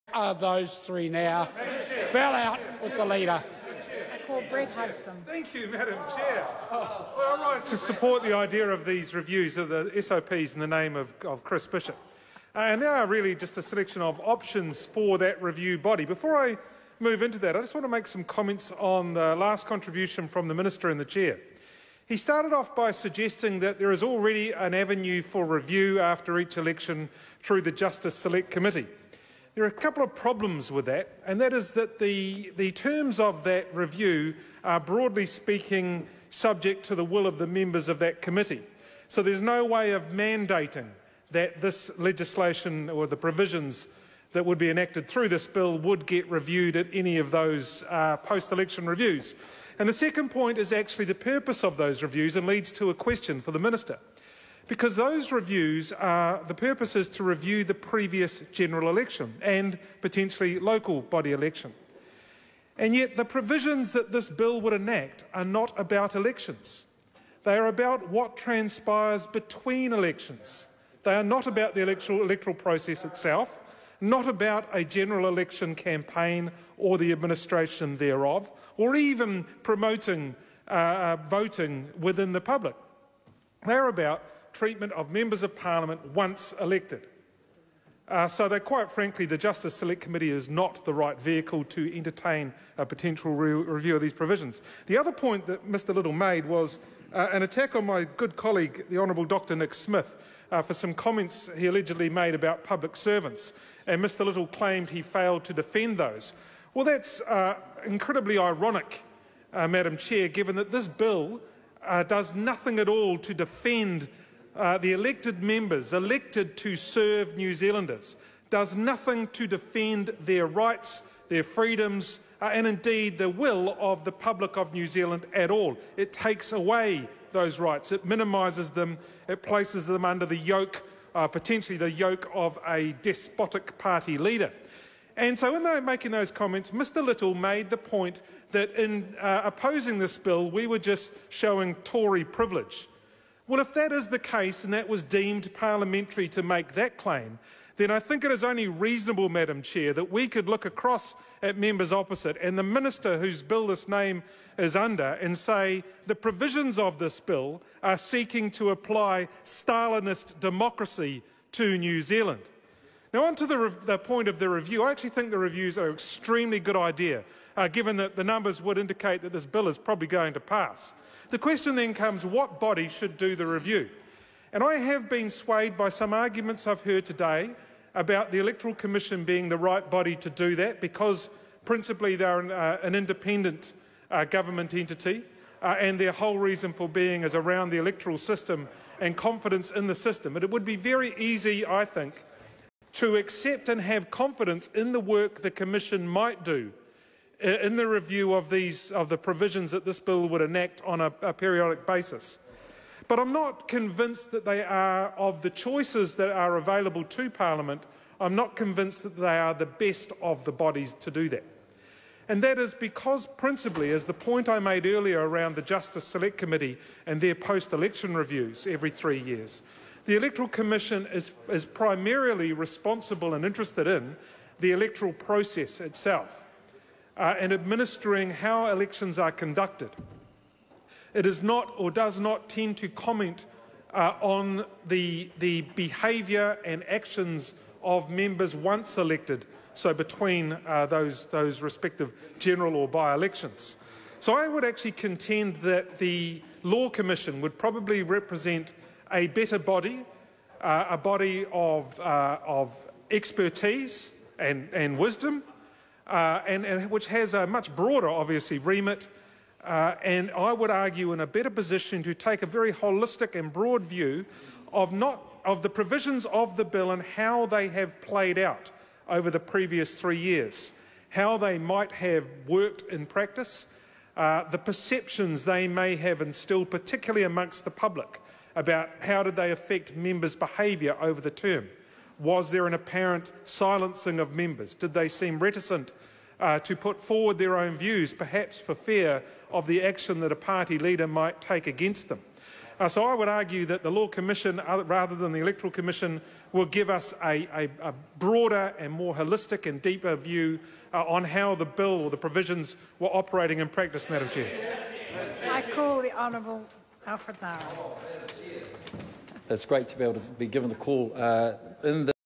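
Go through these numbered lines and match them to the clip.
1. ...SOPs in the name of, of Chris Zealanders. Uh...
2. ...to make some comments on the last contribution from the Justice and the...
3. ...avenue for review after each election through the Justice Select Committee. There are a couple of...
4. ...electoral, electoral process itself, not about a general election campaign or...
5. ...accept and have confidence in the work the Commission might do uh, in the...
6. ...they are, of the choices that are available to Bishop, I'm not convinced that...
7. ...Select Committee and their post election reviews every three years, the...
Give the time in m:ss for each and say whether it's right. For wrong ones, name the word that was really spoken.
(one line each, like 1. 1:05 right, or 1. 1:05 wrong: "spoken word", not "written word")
1. 0:09 wrong: "Bishop", not "Zealanders"
2. 0:17 wrong: "Minister", not "Justice"
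3. 0:24 right
4. 1:11 right
5. 3:13 right
6. 3:24 wrong: "Parliament", not "Bishop"
7. 3:36 right.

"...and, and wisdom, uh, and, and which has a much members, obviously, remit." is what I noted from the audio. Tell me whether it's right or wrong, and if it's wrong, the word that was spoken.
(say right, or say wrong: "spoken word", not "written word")
wrong: "broader", not "members".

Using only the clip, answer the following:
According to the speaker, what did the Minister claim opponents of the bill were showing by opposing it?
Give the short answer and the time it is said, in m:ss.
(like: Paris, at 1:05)
Tory privilege, at 2:21.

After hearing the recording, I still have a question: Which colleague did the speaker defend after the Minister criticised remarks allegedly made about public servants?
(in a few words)
Dr Nick Smith.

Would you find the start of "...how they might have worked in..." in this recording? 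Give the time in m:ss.
4:31.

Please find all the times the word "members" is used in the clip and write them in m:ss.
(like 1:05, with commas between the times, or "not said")
0:37, 1:25, 1:55, 2:31, 3:58, 4:39, 4:44.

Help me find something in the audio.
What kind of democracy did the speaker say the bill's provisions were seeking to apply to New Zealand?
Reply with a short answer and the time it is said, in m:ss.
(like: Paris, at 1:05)
Stalinist democracy, at 2:39.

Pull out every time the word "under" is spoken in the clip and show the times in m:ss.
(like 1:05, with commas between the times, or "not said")
2:10, 2:34.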